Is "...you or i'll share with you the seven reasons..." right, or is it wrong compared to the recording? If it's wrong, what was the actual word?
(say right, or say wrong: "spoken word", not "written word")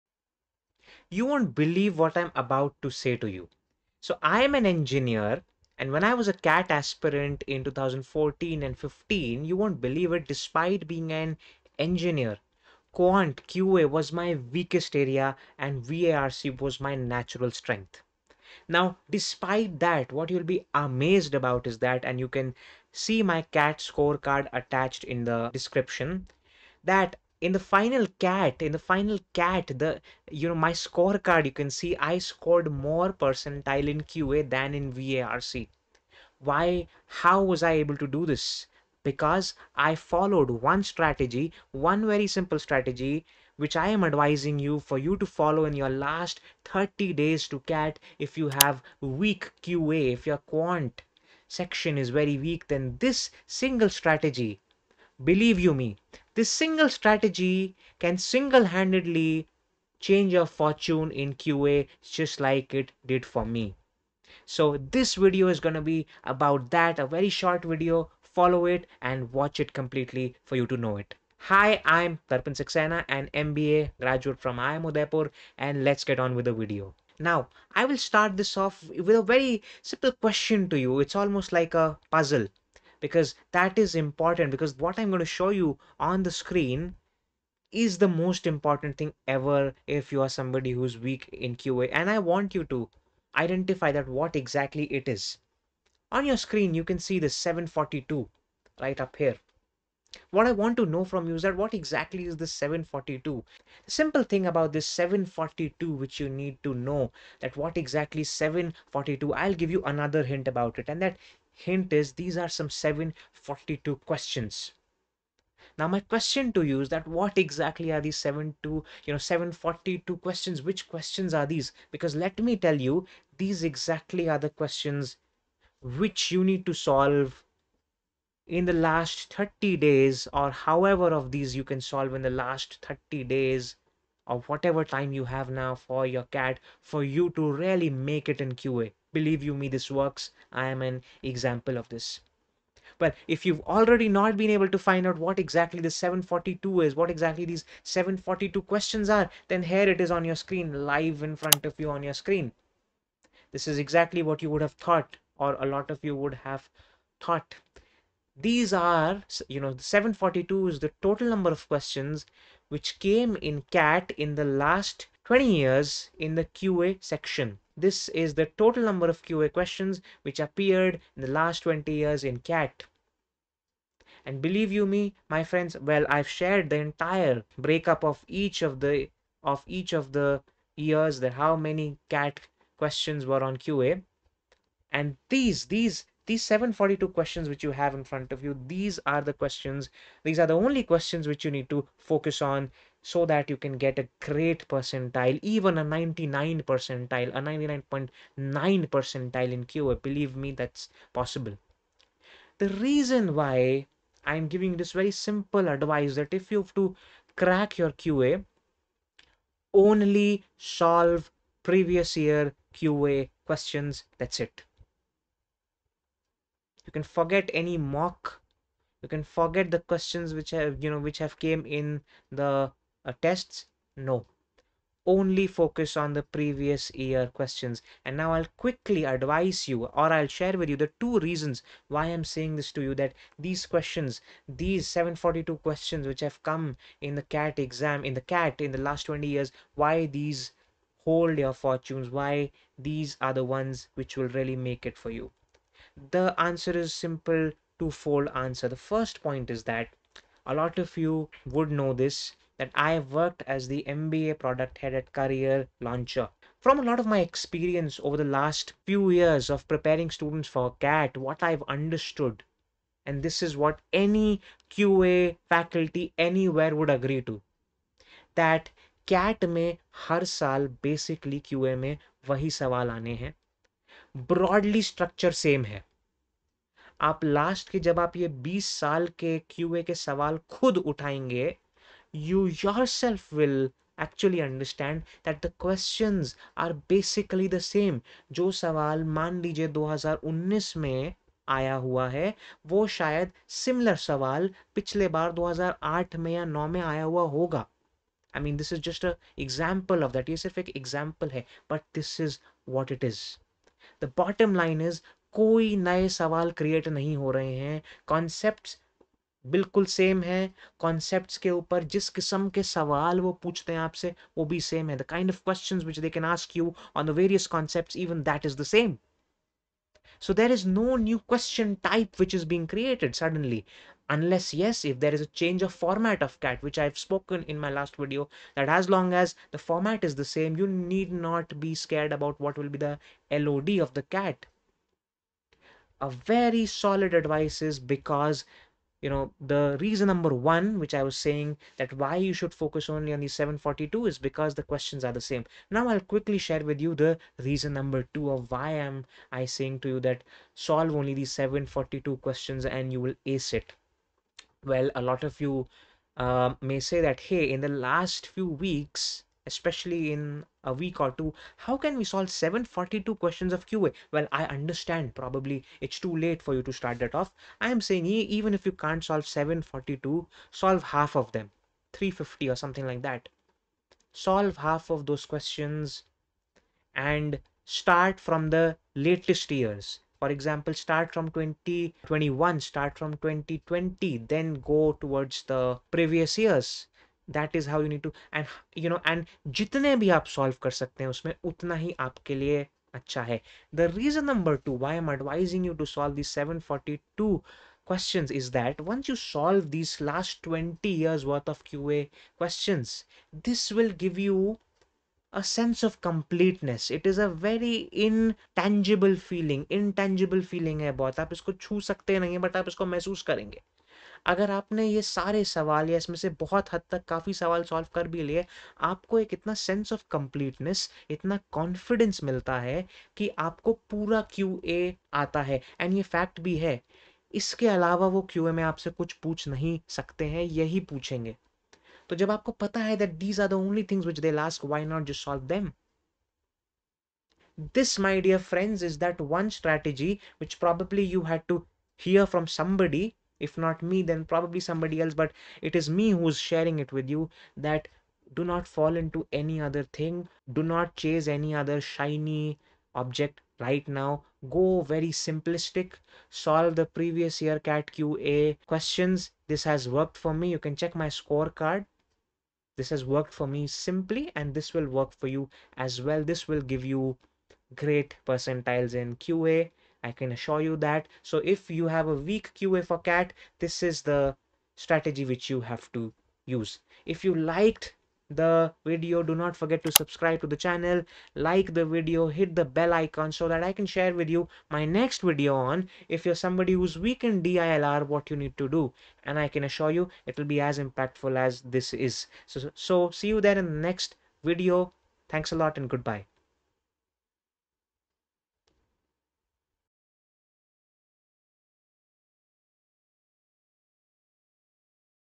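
wrong: "two", not "seven".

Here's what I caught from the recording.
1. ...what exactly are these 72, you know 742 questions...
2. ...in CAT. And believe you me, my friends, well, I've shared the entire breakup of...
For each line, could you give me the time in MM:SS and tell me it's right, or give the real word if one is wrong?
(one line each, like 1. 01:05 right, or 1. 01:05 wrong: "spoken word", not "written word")
1. 01:57 right
2. 02:52 right.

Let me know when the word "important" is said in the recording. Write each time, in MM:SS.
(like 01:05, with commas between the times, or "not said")
01:23, 01:28.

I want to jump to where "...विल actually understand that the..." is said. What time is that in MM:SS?
04:43.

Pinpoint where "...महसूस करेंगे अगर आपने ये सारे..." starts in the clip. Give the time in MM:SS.
06:52.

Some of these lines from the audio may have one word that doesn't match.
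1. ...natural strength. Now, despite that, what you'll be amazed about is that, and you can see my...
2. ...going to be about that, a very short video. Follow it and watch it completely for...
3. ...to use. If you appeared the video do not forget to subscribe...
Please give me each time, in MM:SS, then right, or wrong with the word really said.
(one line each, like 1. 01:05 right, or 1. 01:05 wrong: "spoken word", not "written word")
1. 00:16 right
2. 01:05 right
3. 07:55 wrong: "liked", not "appeared".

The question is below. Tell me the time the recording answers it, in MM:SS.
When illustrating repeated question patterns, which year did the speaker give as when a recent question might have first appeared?
04:55.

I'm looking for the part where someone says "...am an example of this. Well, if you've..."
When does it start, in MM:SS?
02:20.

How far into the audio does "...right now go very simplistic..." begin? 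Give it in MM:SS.
07:33.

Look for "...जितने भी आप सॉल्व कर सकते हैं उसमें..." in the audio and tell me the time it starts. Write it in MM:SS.
06:29.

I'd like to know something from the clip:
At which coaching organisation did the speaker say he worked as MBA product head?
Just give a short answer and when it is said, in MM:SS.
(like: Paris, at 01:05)
Career Launcher, at 04:15.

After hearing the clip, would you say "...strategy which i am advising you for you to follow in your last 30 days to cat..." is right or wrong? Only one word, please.
right.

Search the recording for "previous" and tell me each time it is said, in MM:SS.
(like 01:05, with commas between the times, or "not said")
03:31, 03:46, 06:25, 07:36.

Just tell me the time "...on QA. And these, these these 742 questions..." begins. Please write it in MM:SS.
03:03.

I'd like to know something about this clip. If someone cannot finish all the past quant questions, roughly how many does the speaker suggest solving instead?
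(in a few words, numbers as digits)
350.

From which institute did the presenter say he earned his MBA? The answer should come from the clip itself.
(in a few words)
IIM Udaipur.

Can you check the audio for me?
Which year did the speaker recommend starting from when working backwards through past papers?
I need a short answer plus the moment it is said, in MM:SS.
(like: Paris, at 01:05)
2021, at 06:21.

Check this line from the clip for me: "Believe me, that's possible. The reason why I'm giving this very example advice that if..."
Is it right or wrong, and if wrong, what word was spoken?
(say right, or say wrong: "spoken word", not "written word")
wrong: "simple", not "example".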